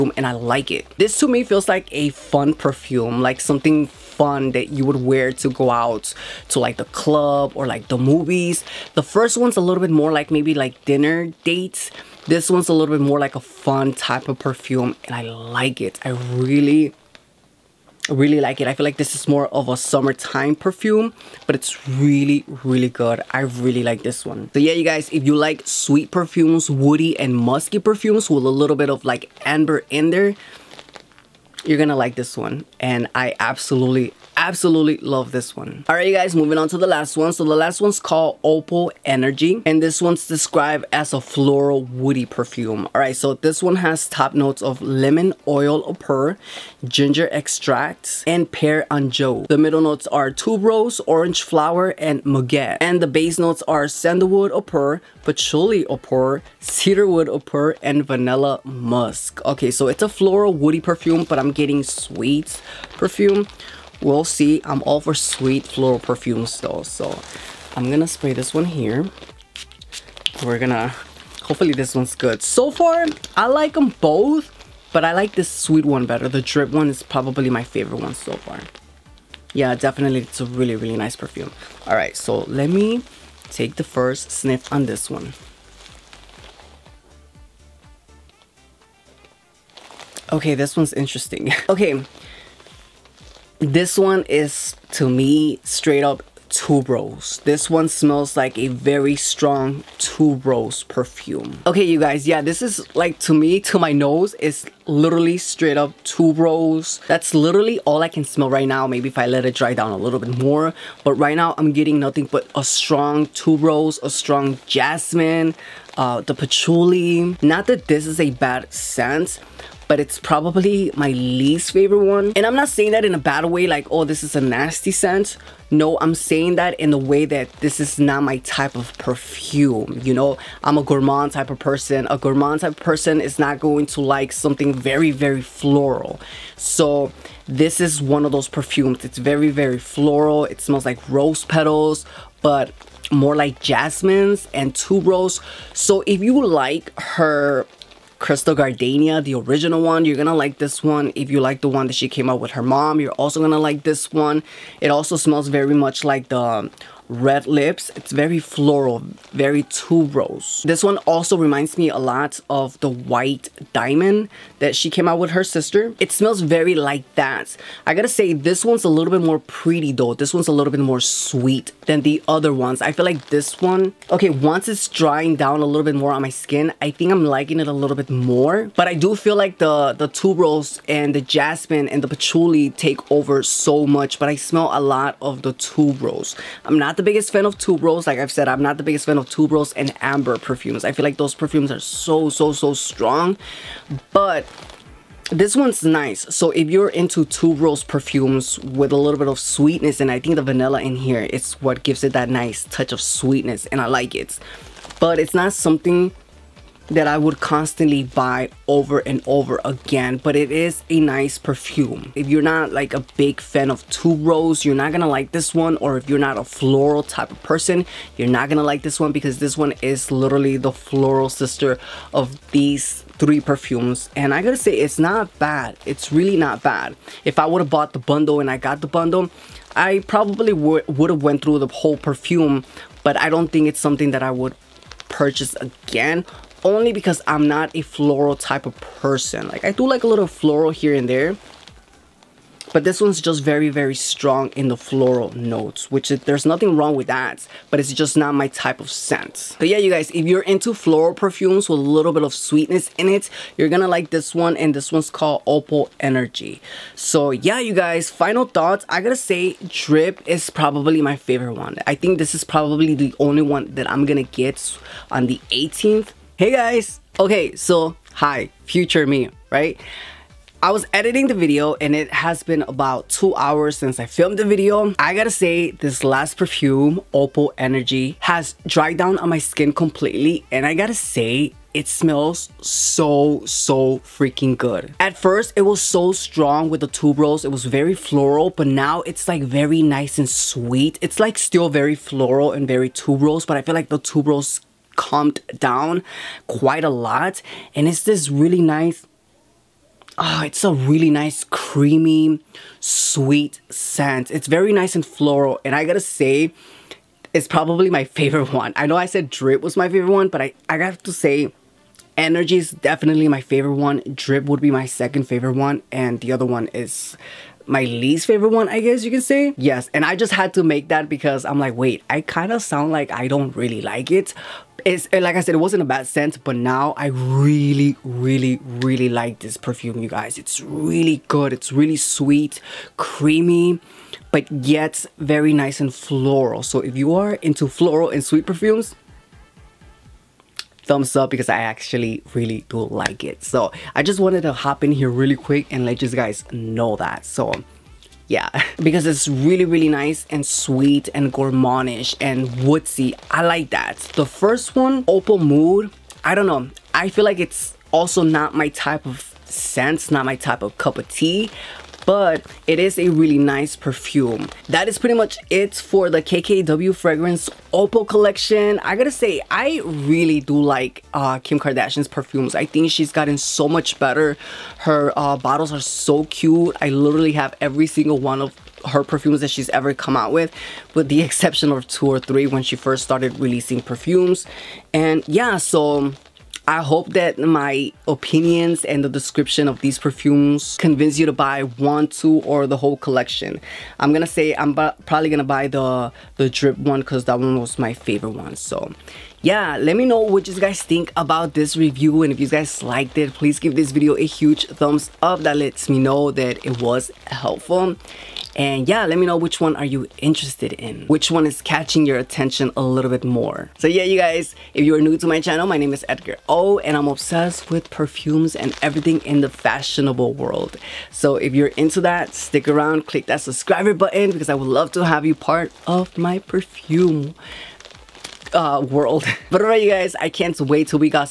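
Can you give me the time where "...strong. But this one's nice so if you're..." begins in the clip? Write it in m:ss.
3:12.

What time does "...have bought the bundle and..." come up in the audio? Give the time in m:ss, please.
3:47.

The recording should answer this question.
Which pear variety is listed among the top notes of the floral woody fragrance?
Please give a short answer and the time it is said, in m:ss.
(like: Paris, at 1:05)
Anjou, at 0:48.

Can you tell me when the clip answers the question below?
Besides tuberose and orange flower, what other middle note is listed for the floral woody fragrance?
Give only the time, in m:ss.
0:52.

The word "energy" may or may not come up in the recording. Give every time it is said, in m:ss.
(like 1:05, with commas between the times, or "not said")
0:39, 4:15, 4:37, 5:12.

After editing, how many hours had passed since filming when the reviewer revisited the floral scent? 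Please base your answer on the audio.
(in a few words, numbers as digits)
2.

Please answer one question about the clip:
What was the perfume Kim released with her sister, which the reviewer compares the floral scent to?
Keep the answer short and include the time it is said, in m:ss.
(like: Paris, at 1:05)
White Diamond, at 2:42.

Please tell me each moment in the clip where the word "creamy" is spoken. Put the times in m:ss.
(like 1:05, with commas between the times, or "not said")
5:01, 5:32.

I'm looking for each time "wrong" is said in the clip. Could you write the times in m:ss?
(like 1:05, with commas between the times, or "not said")
4:06.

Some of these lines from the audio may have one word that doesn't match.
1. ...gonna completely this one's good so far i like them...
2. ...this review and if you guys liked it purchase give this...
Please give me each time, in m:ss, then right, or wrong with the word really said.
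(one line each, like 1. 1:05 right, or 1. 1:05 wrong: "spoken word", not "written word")
1. 1:10 wrong: "hopefully", not "completely"
2. 6:41 wrong: "please", not "purchase".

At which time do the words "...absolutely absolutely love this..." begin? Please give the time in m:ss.
0:33.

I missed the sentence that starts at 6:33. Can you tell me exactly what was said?
I'm gonna say I'm probably gonna buy the the drip one because that one was my favorite one.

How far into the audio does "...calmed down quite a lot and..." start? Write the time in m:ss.
4:54.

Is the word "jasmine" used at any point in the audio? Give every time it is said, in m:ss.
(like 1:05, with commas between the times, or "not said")
1:54, 2:23, 3:01.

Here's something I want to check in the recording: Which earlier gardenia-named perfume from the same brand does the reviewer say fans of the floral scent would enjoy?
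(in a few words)
Crystal Gardenia.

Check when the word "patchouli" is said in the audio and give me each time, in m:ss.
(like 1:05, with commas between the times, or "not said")
0:55, 1:56, 3:02.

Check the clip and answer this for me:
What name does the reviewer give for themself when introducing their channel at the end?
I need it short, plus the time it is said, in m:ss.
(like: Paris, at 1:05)
Edgar O, at 6:56.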